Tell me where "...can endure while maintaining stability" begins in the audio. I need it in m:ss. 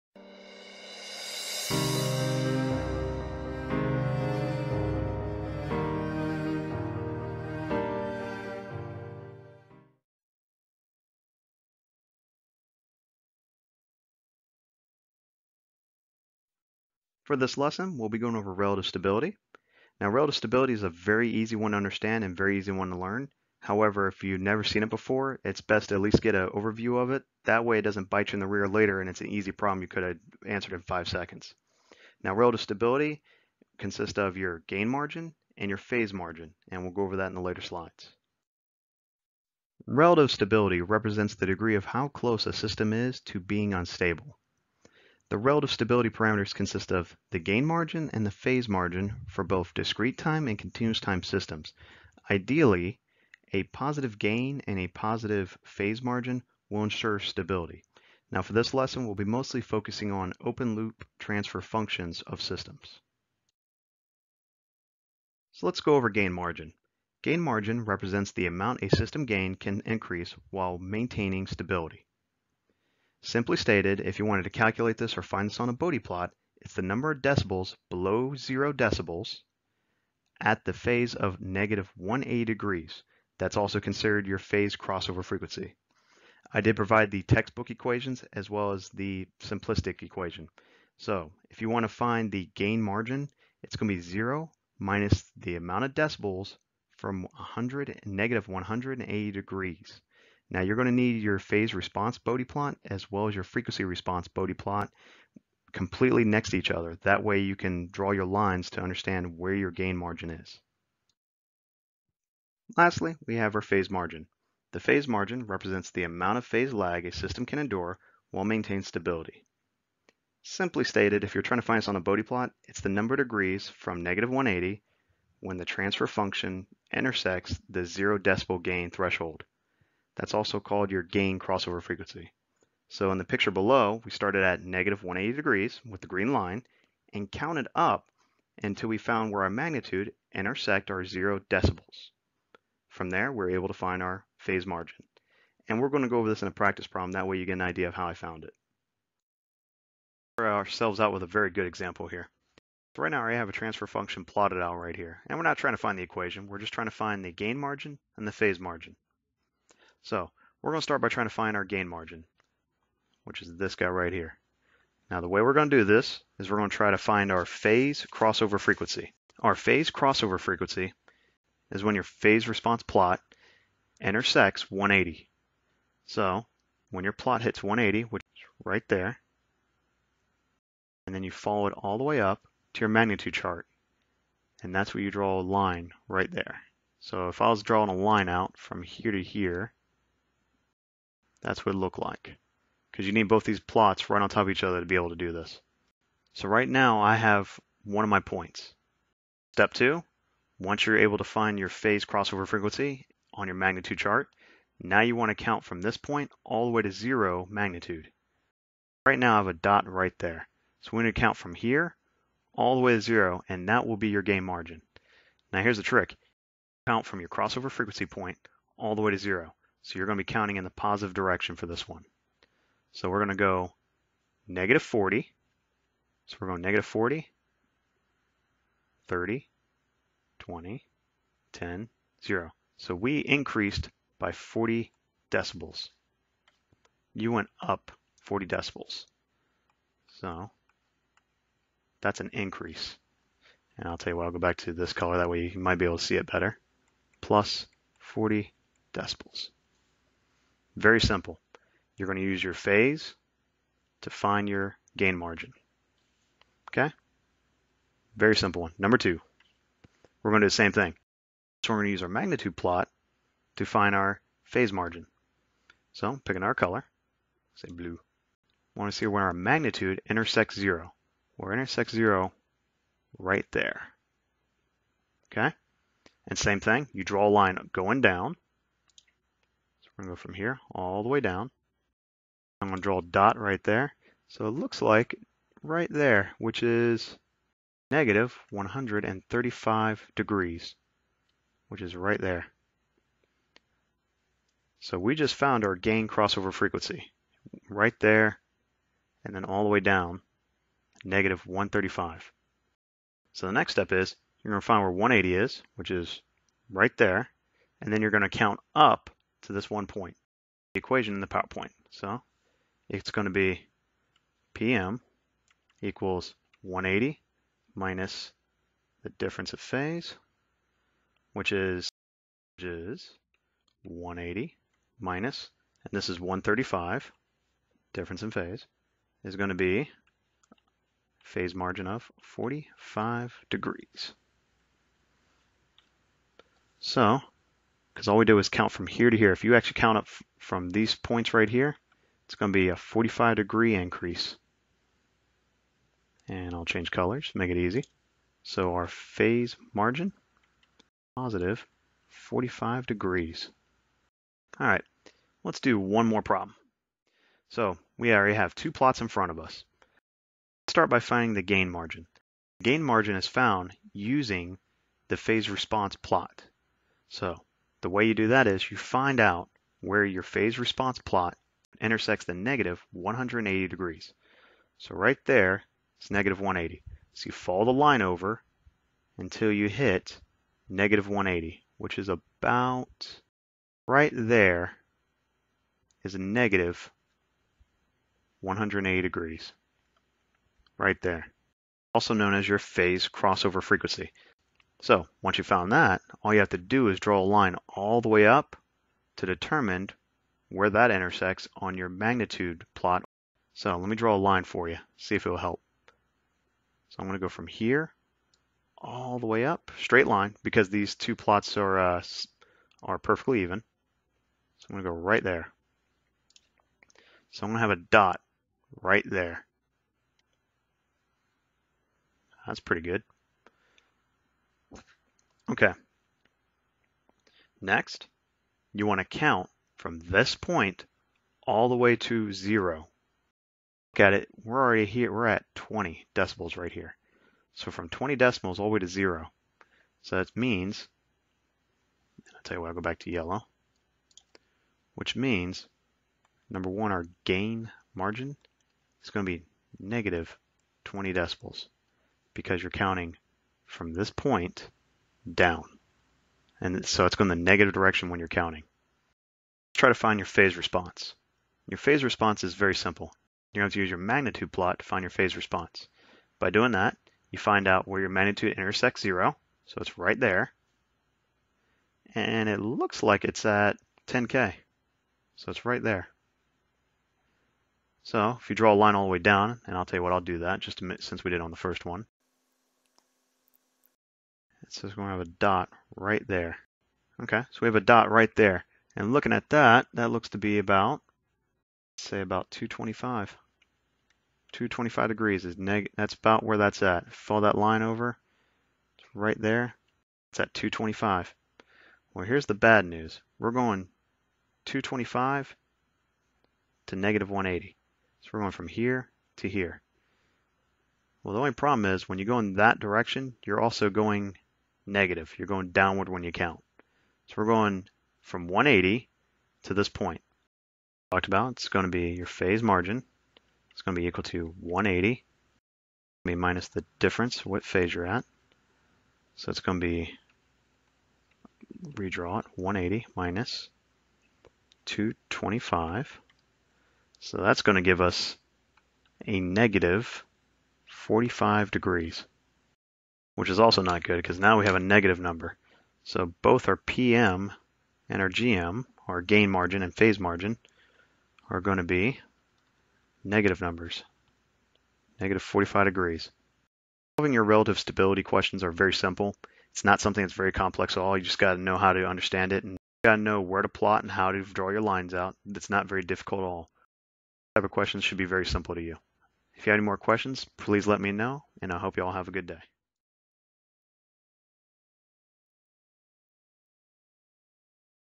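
1:57.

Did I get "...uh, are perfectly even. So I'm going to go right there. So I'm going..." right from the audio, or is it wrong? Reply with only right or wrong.
right.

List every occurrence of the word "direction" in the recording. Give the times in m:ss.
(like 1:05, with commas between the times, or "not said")
3:41, 7:37, 8:32.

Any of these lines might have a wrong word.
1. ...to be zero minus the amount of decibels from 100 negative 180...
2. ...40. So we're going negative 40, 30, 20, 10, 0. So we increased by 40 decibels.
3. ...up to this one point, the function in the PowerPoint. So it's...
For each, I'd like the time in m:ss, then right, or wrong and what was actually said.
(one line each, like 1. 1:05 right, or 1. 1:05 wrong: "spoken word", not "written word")
1. 1:33 right
2. 3:44 right
3. 5:08 wrong: "equation", not "function".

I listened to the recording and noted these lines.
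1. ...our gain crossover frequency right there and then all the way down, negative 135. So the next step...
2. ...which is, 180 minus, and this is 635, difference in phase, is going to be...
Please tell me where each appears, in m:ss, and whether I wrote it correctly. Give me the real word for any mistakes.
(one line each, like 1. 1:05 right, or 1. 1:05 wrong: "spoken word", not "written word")
1. 4:55 right
2. 5:21 wrong: "135", not "635".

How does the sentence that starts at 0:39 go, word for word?
Relative stability represents the degree of how close a system is to being unstable.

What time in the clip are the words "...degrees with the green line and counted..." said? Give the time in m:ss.
2:15.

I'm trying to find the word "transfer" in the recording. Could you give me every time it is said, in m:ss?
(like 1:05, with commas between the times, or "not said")
1:01, 2:05, 2:33.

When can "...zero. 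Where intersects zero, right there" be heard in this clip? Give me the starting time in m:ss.
4:30.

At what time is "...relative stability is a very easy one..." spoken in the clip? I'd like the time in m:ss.
0:20.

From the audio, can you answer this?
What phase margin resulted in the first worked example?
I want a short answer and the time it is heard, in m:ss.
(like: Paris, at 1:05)
45 degrees, at 5:51.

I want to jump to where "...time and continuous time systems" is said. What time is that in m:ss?
0:50.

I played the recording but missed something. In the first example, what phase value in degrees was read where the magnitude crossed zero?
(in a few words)
-135 degrees.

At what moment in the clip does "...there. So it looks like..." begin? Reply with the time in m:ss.
4:43.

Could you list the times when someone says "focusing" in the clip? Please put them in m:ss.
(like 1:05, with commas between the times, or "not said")
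0:59.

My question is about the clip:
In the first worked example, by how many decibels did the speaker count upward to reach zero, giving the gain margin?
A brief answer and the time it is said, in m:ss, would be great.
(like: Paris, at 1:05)
40 decibels, at 4:07.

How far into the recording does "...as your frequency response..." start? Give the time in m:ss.
1:43.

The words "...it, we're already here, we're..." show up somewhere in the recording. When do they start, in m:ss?
7:14.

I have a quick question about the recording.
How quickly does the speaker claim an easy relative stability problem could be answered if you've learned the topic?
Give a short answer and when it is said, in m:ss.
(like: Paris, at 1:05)
5 seconds, at 0:30.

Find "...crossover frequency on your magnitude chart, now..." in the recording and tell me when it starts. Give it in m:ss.
3:22.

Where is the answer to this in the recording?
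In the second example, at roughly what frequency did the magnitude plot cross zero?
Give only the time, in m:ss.
7:54.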